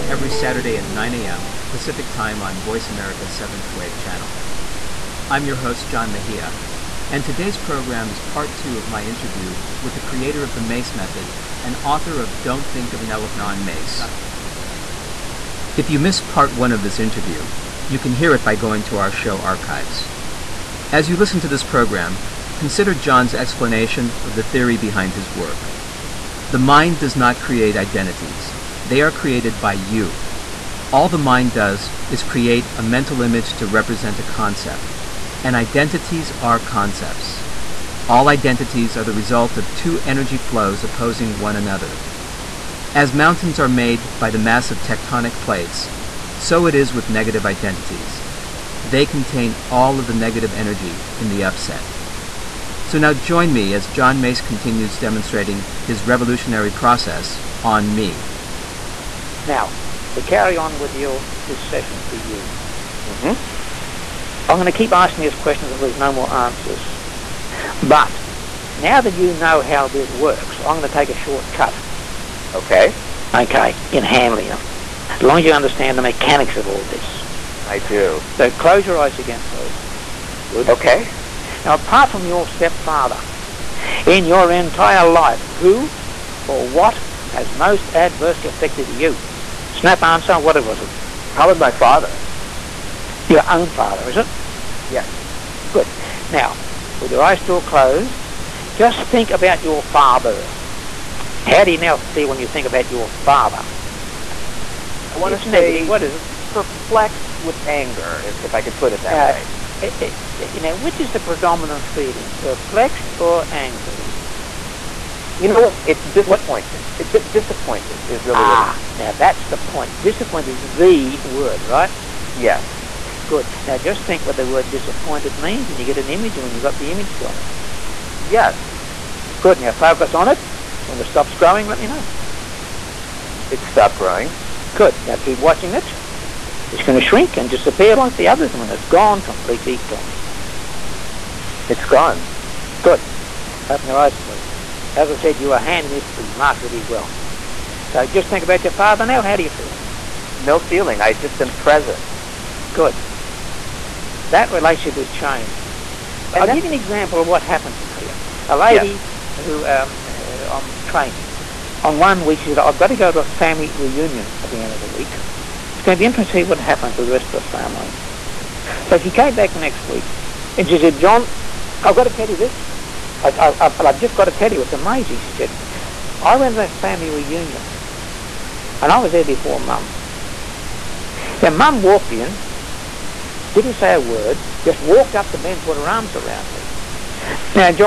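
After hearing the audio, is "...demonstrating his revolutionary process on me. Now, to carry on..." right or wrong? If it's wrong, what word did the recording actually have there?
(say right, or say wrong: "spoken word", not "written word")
right.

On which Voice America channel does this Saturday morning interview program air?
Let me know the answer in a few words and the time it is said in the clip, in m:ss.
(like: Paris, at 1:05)
Seventh Wave Channel, at 0:03.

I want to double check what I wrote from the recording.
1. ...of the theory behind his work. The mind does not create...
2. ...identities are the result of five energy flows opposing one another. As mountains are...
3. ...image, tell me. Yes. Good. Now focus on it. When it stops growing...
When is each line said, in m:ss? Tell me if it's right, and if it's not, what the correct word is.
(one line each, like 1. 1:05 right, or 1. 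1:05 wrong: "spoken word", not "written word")
1. 0:24 right
2. 0:38 wrong: "two", not "five"
3. 2:06 right.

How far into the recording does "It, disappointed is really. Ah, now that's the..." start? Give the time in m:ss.
1:57.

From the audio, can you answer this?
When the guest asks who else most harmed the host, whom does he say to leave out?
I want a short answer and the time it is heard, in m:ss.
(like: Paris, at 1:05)
Stepfather, at 1:22.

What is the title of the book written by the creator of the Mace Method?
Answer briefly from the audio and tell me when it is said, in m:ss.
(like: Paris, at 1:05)
Don't Think of an Elephant, at 0:12.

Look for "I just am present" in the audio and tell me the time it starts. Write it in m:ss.
2:31.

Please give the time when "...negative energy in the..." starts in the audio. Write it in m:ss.
0:50.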